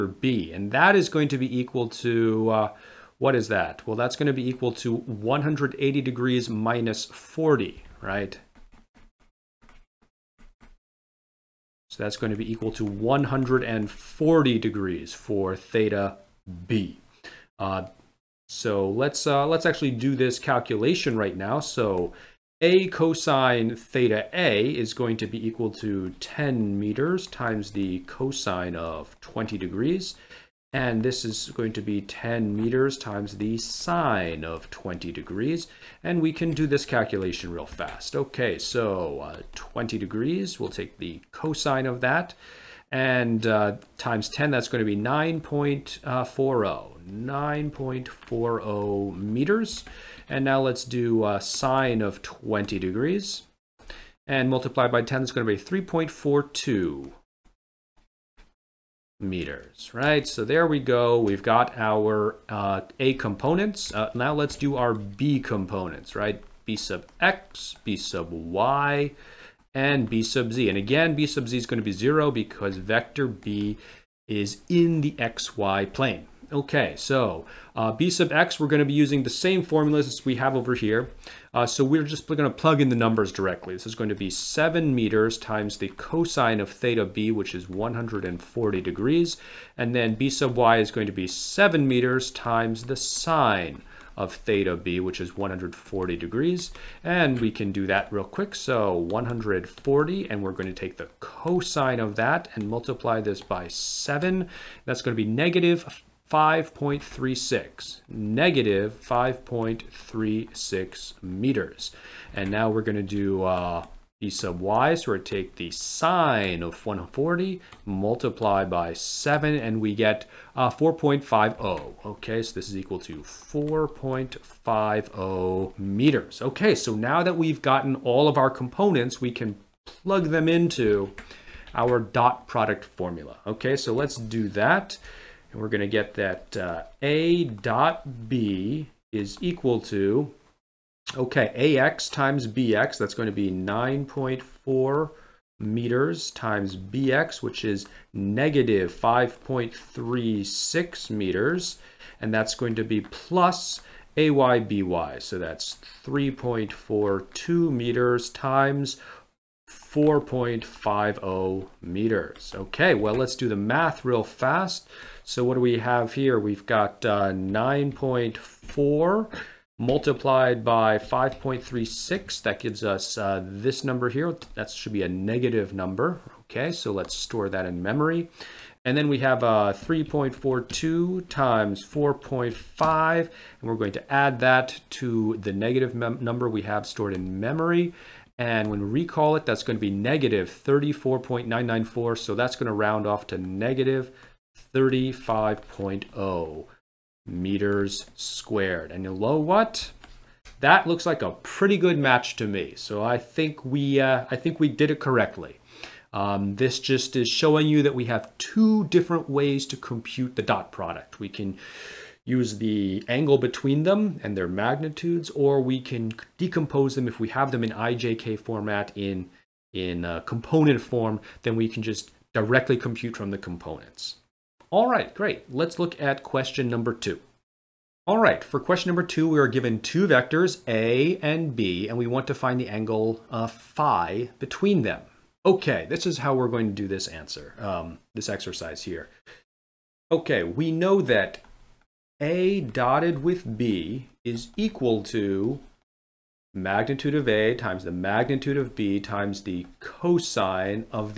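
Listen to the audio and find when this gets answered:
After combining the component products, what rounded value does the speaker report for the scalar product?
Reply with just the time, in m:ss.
3:13.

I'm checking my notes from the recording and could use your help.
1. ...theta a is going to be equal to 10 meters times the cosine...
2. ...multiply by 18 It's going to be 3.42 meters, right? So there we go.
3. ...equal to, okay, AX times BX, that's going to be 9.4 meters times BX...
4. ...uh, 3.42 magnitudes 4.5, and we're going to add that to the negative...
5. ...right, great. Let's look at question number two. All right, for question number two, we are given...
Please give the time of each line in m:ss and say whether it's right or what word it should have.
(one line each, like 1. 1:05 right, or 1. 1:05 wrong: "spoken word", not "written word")
1. 0:23 right
2. 0:54 wrong: "10", not "18"
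3. 2:19 right
4. 2:59 wrong: "times", not "magnitudes"
5. 3:44 right.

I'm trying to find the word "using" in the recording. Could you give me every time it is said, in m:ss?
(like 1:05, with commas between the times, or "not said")
1:18.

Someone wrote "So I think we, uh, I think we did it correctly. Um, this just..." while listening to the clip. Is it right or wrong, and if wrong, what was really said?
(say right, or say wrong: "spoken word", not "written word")
right.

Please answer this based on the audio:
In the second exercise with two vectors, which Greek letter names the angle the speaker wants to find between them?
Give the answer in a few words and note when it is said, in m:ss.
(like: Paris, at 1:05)
phi, at 3:53.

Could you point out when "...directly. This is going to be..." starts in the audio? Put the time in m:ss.
1:23.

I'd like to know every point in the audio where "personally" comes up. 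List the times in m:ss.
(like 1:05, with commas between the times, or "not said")
not said.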